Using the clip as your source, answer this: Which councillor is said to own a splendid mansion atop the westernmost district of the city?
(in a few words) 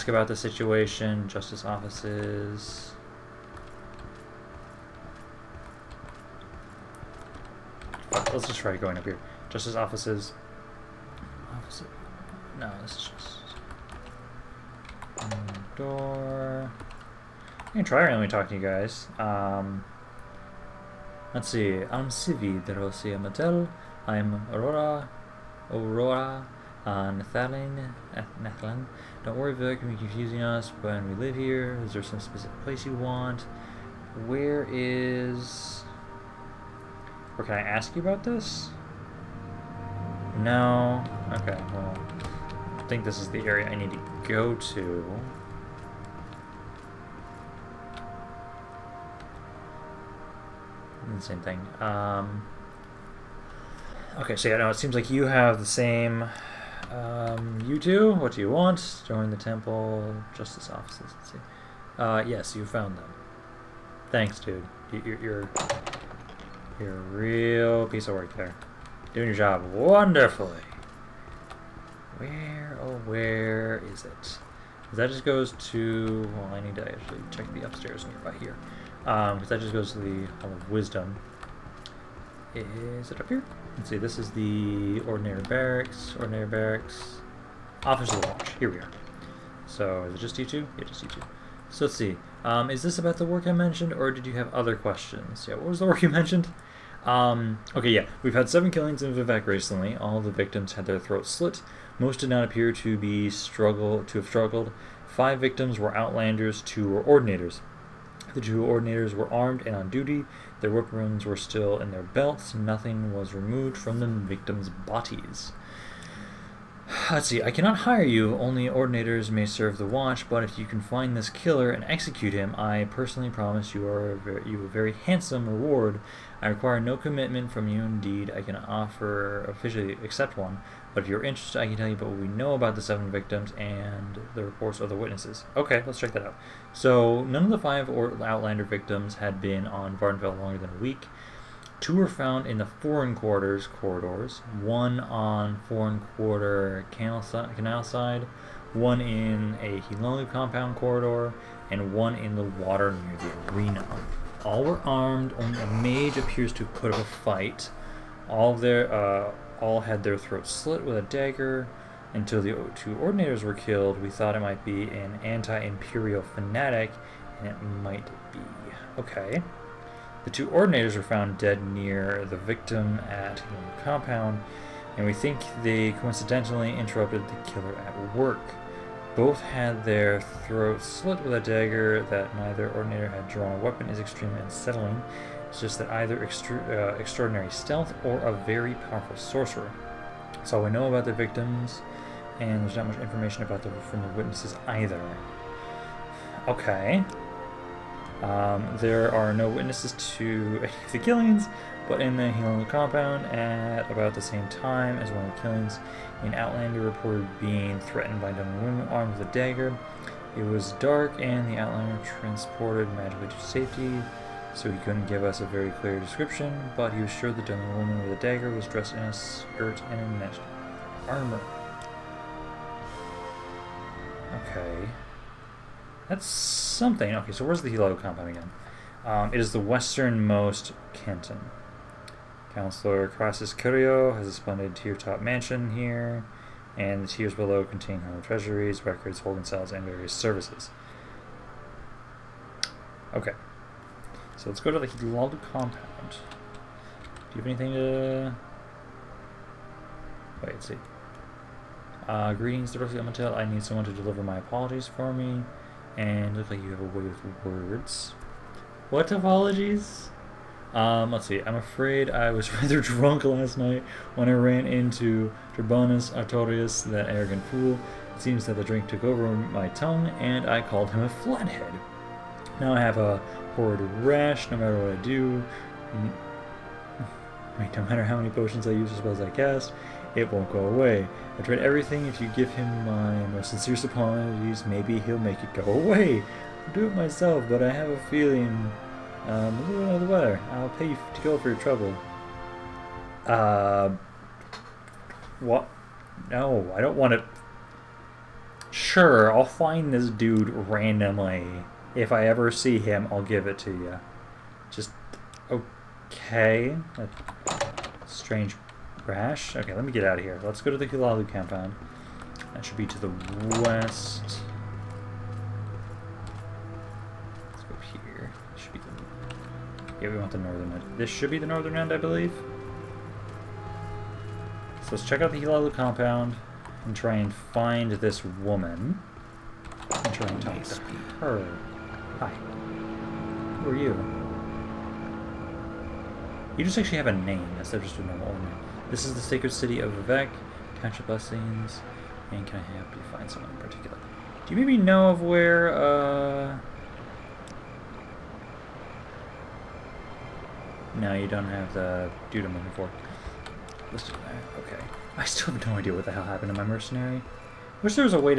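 Crassius Curio.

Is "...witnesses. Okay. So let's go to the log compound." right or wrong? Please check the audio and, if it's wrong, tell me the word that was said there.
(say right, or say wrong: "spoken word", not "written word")
wrong: "services", not "witnesses".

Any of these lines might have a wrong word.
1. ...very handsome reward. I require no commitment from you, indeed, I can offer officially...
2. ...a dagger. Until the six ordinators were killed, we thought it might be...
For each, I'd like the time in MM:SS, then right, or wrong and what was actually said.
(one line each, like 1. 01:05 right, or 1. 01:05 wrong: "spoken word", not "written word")
1. 02:04 right
2. 02:40 wrong: "two", not "six".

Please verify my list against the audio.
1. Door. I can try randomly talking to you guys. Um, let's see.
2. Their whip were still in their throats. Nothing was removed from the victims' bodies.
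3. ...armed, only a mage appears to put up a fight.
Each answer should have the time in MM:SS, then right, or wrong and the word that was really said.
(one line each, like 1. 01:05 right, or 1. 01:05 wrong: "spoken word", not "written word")
1. 00:15 right
2. 01:50 wrong: "belts", not "throats"
3. 02:34 right.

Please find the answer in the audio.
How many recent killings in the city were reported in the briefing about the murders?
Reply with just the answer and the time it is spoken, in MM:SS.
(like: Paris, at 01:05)
7, at 01:38.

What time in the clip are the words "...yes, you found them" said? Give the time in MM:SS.
01:02.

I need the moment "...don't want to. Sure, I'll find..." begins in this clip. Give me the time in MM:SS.
04:56.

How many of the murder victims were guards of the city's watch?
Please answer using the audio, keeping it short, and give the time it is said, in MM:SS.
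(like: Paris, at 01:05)
2, at 01:46.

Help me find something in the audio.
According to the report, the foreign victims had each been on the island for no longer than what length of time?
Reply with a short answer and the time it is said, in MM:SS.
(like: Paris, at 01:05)
a week, at 02:20.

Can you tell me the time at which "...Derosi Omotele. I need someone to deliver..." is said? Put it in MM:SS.
04:12.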